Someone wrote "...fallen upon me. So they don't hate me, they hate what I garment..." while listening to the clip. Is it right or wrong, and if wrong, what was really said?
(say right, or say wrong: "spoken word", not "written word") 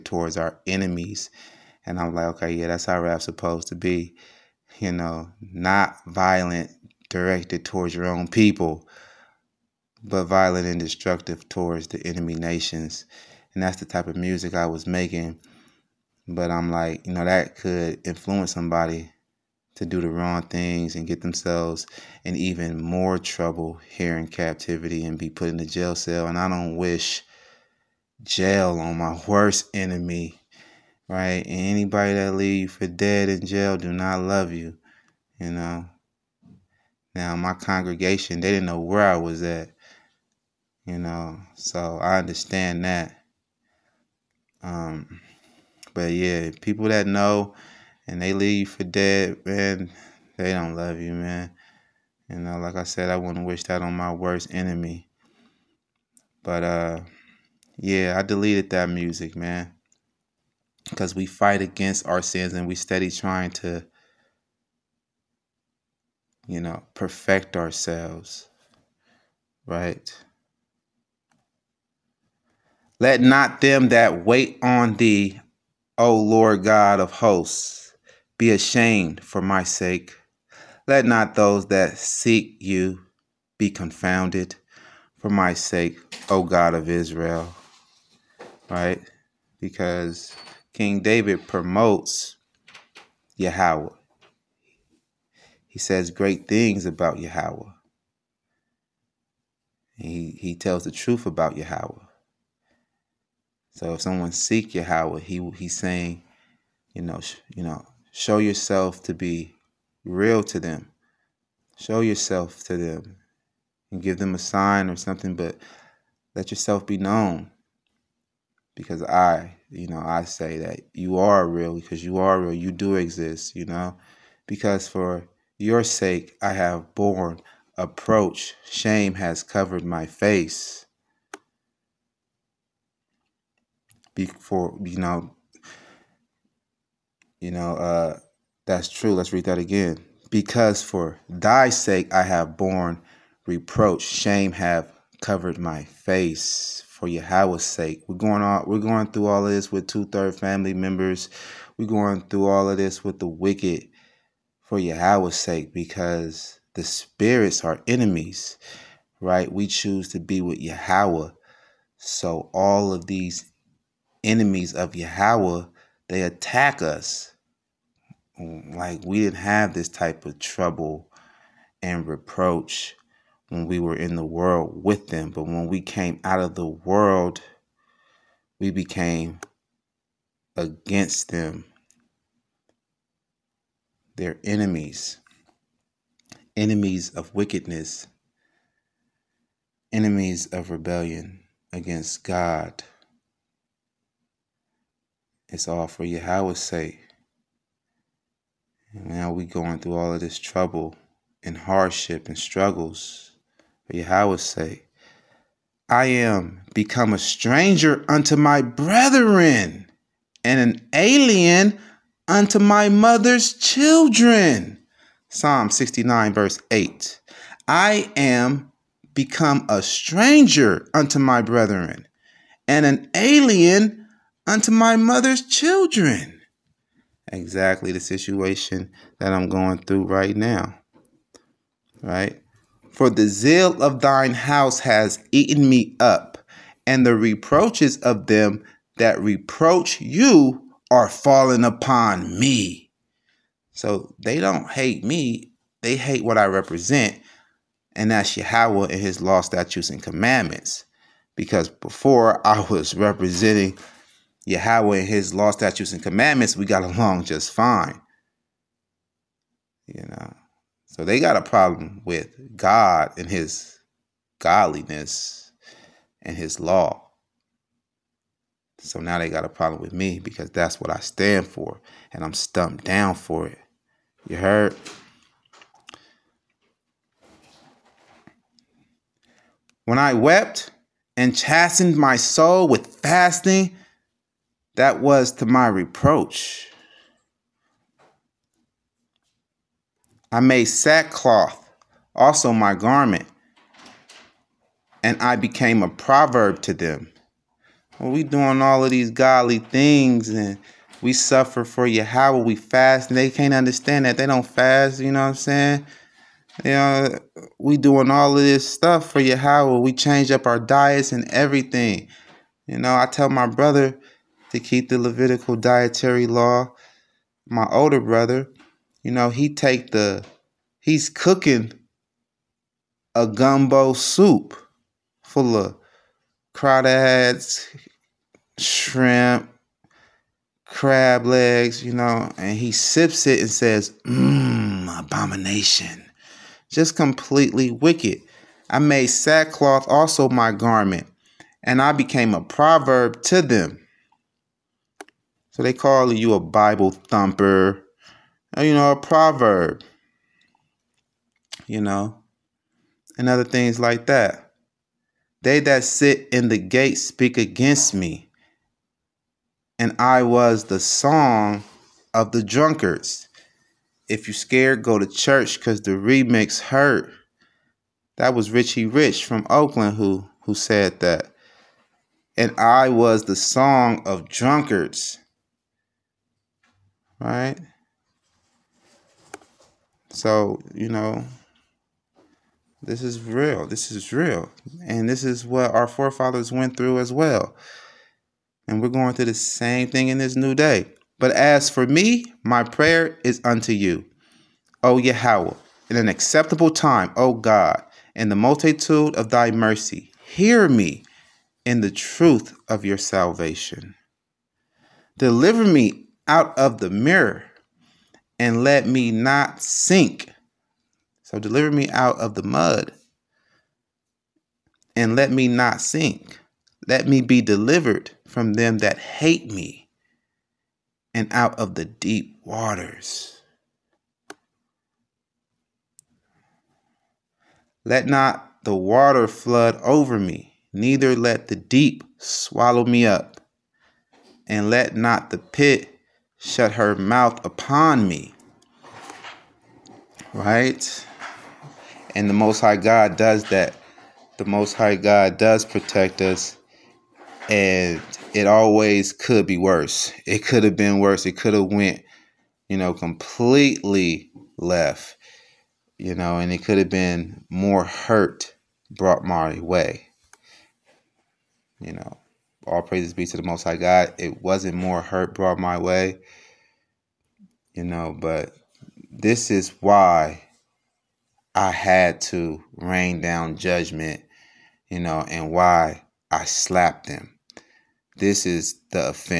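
wrong: "represent", not "garment".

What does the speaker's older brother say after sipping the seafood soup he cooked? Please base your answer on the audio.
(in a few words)
abomination.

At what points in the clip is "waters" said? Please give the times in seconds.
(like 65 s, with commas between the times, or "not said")
422 s, 428 s.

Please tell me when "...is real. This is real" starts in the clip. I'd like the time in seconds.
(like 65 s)
383 s.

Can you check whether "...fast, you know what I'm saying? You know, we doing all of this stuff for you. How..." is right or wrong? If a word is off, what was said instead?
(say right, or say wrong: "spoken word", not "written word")
right.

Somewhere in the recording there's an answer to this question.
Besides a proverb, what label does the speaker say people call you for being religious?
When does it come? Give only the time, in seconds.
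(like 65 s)
346 s.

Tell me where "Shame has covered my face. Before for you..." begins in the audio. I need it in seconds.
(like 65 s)
128 s.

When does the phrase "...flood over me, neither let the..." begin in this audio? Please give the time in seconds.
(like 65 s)
429 s.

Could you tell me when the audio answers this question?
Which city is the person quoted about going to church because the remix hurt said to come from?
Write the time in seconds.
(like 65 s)
369 s.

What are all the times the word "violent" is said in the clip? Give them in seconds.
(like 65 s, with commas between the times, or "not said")
6 s, 10 s.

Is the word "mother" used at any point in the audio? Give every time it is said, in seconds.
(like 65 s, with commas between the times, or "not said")
212 s, 224 s.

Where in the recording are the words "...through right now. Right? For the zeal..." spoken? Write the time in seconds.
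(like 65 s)
229 s.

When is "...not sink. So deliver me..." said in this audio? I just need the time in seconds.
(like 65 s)
409 s.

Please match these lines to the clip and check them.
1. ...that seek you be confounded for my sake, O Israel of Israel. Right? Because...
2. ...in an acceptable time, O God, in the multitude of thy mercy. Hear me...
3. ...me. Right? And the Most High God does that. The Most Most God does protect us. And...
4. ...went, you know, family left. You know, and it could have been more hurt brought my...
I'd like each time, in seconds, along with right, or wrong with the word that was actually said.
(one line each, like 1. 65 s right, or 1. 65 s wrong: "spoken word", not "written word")
1. 81 s wrong: "God", not "Israel"
2. 395 s right
3. 438 s wrong: "High", not "Most"
4. 451 s wrong: "completely", not "family".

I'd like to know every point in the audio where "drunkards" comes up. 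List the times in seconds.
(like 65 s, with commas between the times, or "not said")
362 s, 374 s.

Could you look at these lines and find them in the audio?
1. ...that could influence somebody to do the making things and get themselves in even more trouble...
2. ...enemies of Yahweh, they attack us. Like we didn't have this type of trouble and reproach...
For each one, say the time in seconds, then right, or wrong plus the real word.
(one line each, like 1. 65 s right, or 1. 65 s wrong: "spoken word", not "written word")
1. 17 s wrong: "wrong", not "making"
2. 164 s right.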